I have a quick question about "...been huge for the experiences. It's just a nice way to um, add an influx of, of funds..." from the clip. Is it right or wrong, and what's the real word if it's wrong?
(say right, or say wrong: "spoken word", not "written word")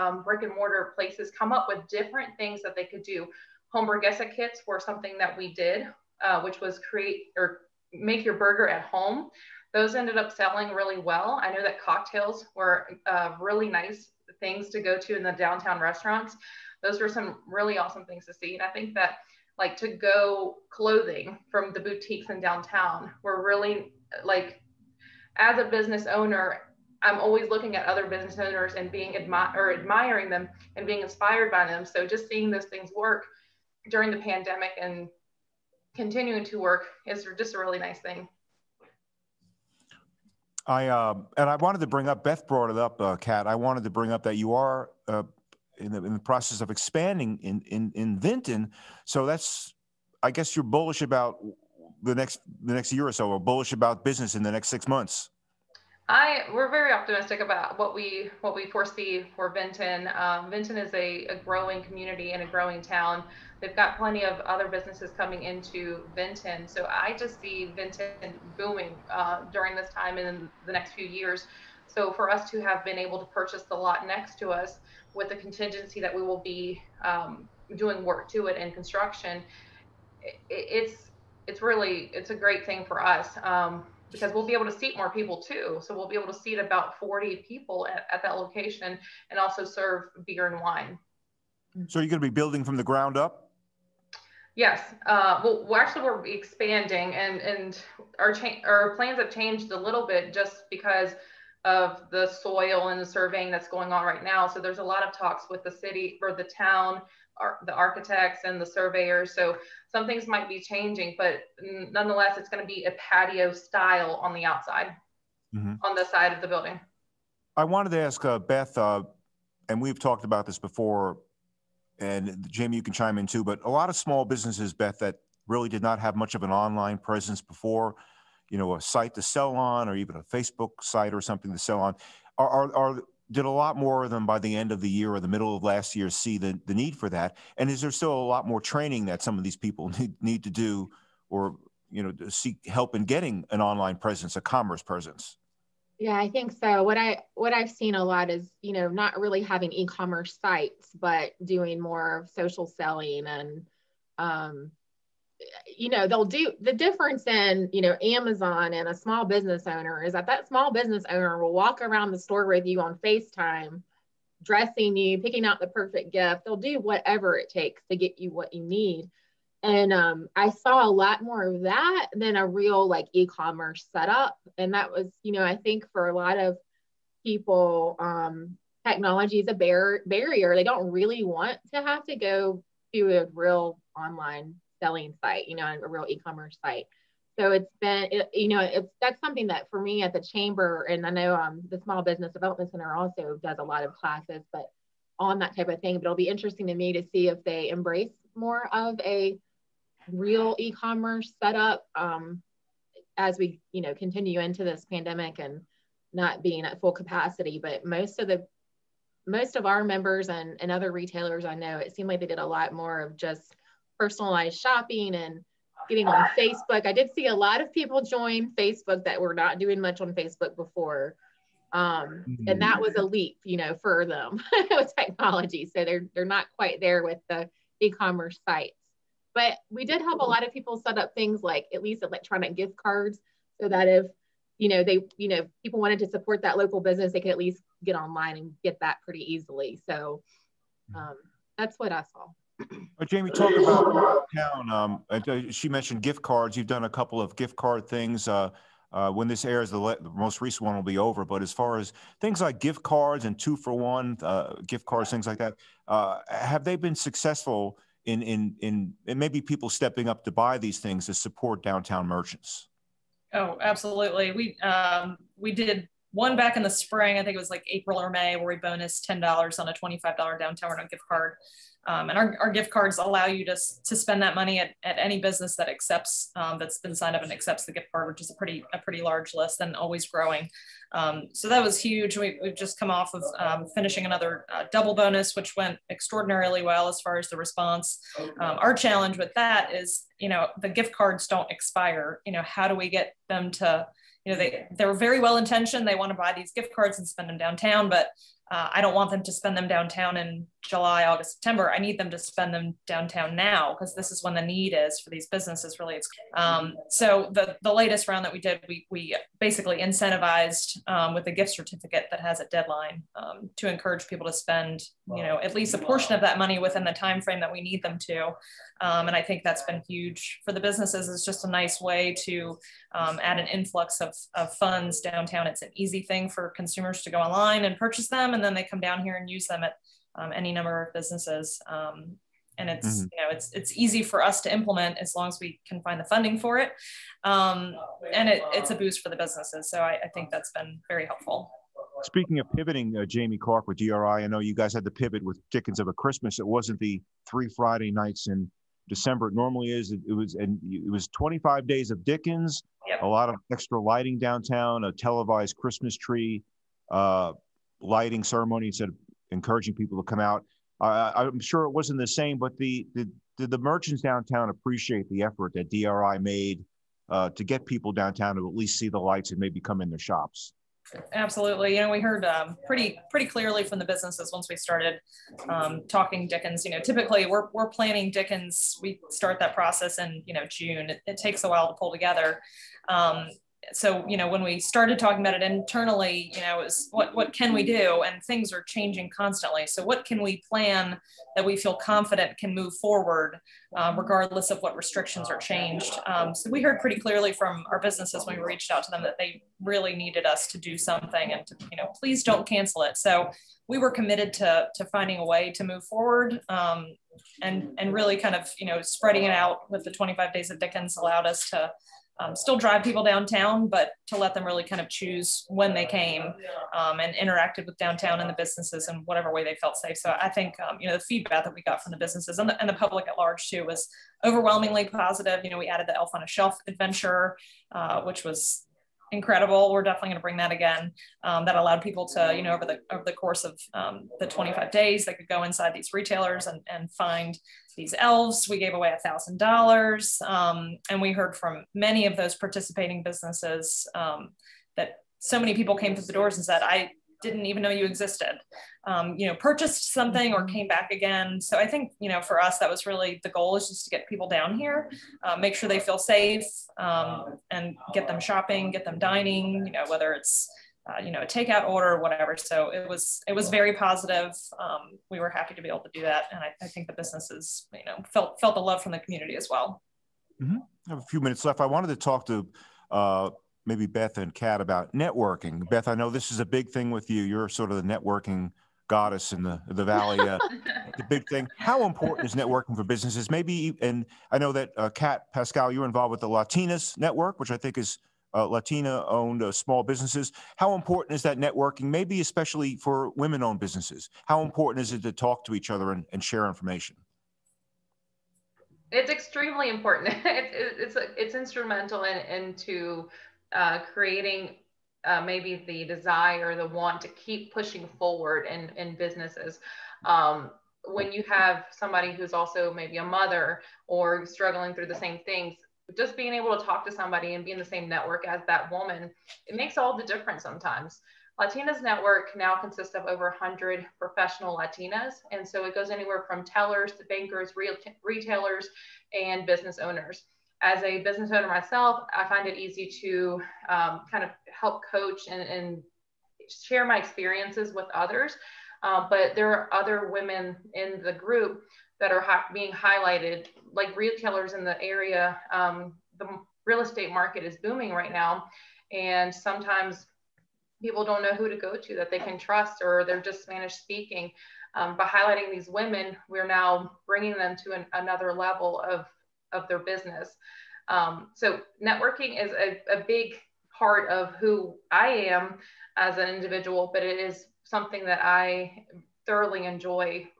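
wrong: "businesses", not "experiences".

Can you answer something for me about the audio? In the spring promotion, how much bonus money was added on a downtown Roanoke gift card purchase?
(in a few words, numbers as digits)
$10.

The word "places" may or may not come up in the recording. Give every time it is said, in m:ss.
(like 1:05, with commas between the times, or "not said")
0:00.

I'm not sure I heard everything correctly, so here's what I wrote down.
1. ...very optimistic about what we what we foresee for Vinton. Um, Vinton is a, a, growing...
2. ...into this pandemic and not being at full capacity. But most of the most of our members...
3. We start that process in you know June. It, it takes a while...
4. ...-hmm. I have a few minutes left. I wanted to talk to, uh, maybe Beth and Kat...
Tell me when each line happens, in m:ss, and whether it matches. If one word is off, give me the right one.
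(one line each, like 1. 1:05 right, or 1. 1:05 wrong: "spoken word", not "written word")
1. 0:56 right
2. 3:24 right
3. 6:18 right
4. 7:50 right.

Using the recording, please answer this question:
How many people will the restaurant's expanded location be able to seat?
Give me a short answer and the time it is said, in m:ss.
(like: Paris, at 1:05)
40, at 1:26.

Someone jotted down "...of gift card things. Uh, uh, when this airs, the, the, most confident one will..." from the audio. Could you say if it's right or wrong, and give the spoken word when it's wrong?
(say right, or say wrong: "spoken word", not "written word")
wrong: "recent", not "confident".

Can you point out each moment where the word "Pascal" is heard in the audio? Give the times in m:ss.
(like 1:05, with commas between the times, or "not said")
8:05.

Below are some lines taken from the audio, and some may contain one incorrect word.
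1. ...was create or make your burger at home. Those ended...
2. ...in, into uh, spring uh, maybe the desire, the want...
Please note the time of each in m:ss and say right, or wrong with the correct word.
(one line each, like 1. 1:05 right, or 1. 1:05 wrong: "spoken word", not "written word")
1. 0:06 right
2. 8:22 wrong: "creating", not "spring".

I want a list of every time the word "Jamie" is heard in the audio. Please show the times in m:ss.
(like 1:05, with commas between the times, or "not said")
2:02, 4:03, 5:43.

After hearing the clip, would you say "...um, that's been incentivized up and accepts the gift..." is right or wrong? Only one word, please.
wrong.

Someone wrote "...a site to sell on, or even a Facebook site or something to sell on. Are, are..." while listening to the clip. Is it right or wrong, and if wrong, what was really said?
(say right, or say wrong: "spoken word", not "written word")
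right.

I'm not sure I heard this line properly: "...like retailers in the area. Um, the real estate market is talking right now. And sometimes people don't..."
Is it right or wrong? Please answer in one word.
wrong.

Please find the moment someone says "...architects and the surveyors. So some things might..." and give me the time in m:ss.
1:47.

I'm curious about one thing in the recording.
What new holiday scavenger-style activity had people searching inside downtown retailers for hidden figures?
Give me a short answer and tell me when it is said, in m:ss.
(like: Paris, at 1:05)
Elf on a Shelf adventure, at 7:05.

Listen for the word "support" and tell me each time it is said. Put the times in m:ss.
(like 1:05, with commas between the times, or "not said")
3:56, 4:21.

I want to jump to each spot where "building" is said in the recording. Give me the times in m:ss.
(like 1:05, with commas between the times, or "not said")
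1:32, 1:56.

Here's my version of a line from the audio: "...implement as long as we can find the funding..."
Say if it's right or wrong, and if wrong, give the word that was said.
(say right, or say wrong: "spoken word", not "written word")
right.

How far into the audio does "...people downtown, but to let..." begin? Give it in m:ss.
6:52.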